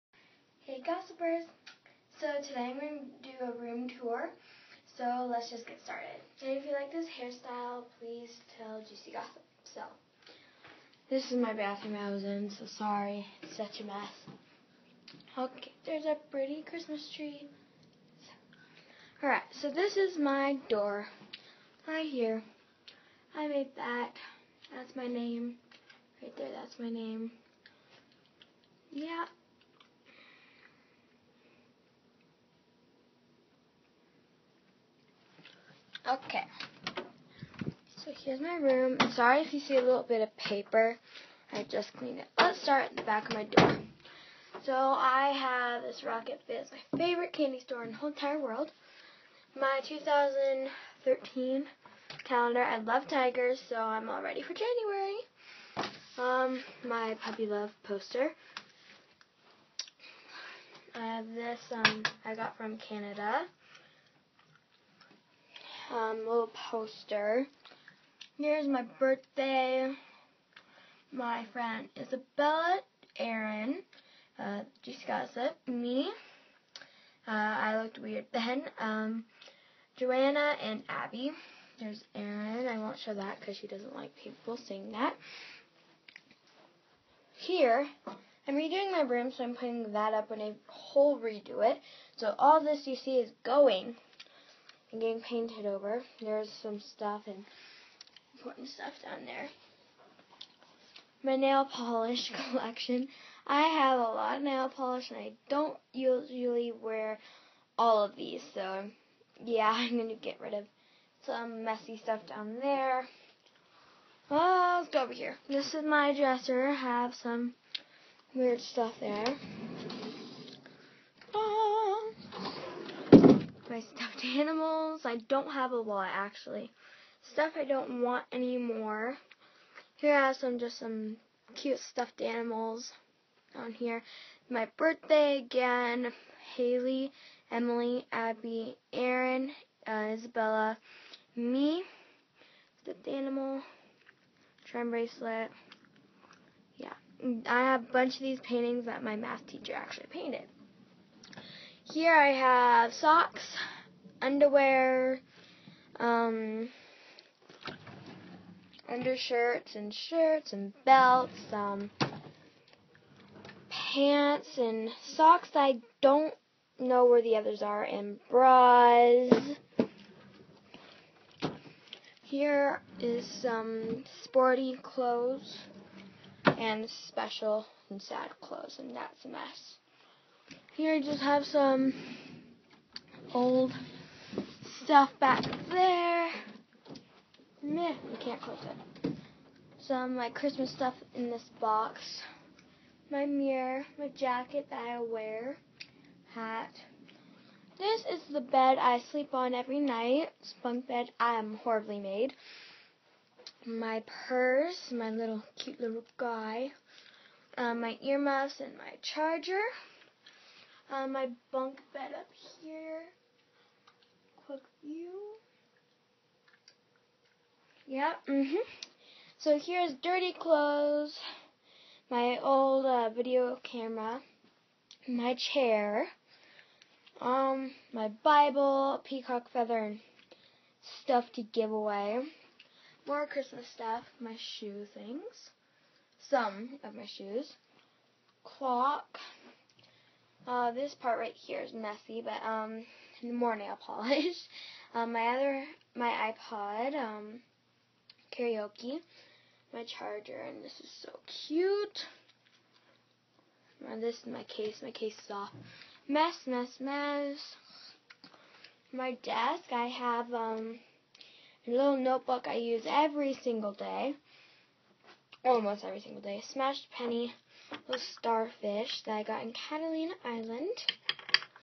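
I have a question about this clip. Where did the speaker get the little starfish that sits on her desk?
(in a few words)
Catalina Island.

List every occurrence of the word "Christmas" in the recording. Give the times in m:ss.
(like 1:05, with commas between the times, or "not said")
0:16, 3:10, 3:53.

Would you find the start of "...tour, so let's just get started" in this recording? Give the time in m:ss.
0:04.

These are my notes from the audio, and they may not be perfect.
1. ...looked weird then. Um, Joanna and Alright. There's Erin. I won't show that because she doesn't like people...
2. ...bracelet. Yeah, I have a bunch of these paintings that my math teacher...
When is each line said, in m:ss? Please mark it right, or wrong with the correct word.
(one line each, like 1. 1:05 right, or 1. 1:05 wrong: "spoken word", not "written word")
1. 1:17 wrong: "Abby", not "Alright"
2. 2:24 right.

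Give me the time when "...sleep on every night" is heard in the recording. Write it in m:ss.
3:19.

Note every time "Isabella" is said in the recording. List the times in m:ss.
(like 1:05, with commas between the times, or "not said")
1:11, 2:20.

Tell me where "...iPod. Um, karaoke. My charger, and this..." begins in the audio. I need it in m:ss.
4:06.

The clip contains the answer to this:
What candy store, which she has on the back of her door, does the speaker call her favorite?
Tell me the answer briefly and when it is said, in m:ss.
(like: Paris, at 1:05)
Rocket Fizz, at 0:46.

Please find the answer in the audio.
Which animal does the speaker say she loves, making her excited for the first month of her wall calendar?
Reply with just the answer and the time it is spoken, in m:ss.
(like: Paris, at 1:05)
Tigers, at 0:53.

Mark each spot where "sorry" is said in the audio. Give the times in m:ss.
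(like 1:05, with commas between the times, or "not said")
0:12, 0:39.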